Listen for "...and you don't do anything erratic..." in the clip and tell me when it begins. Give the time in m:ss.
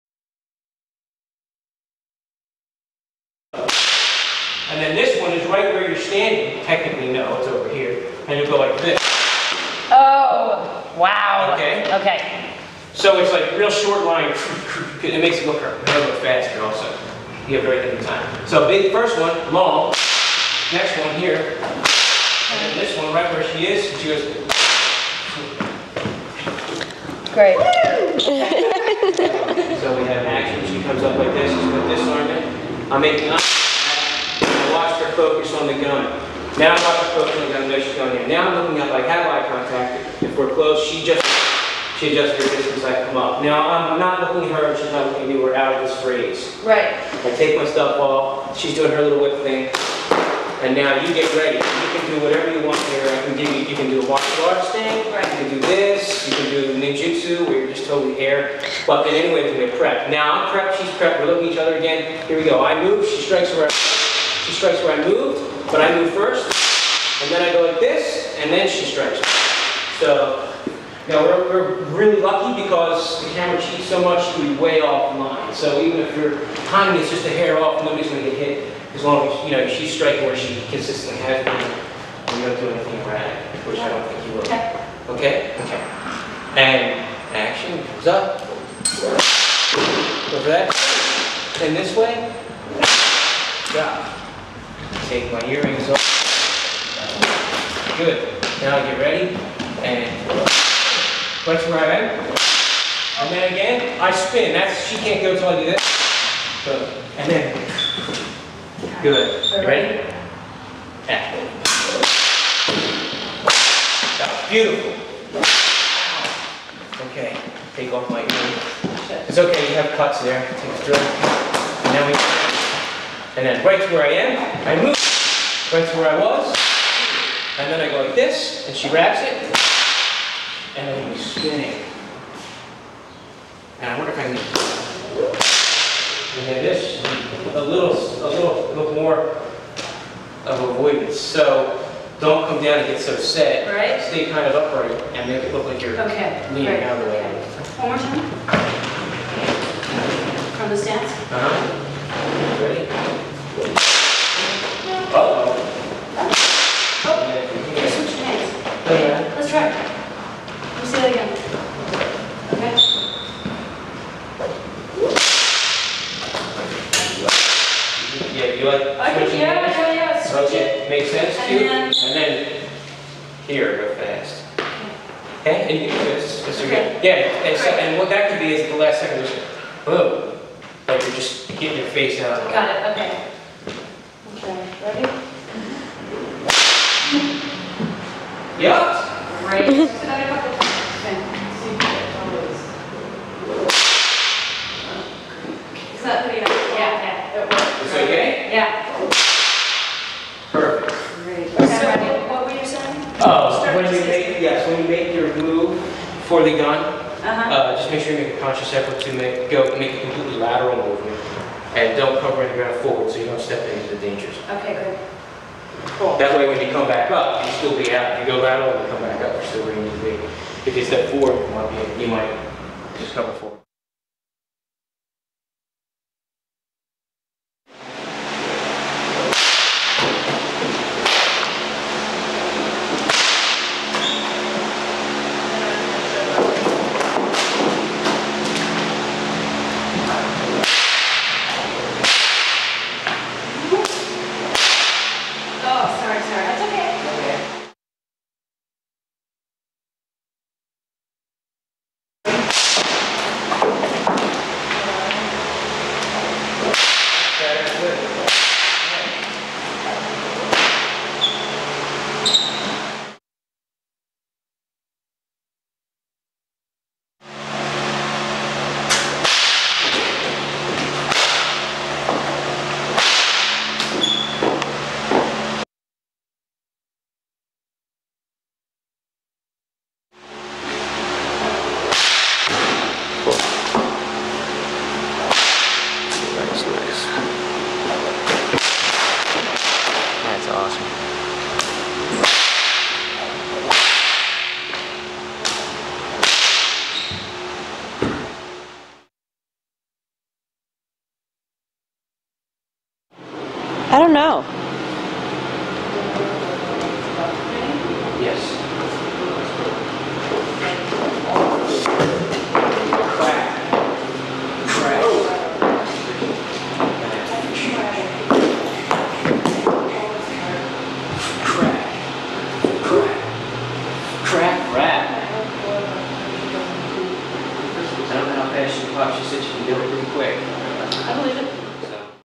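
1:21.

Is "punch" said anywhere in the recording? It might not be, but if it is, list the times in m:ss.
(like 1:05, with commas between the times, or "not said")
1:41.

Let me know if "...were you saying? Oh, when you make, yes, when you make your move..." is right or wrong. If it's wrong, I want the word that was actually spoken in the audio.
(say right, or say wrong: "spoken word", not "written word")
right.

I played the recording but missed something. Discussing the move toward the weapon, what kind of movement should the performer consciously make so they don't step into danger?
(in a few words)
completely lateral.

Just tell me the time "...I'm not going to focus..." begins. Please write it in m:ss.
0:36.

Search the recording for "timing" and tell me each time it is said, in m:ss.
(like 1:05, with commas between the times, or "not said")
1:16.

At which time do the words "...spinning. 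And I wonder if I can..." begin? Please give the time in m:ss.
2:11.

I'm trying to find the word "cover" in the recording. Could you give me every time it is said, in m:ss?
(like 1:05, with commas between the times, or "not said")
3:32, 3:43.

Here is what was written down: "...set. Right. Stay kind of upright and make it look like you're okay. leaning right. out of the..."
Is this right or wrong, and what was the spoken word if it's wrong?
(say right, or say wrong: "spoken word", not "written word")
right.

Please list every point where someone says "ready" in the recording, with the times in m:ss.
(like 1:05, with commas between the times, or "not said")
0:51, 1:38, 1:49, 2:32, 3:09.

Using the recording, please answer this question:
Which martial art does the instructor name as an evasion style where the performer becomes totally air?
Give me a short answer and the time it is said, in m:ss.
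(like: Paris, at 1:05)
ninjutsu, at 0:56.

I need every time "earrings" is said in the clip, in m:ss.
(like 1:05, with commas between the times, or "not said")
1:35, 1:58.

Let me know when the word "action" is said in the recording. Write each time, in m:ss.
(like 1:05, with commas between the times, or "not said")
0:30, 1:27.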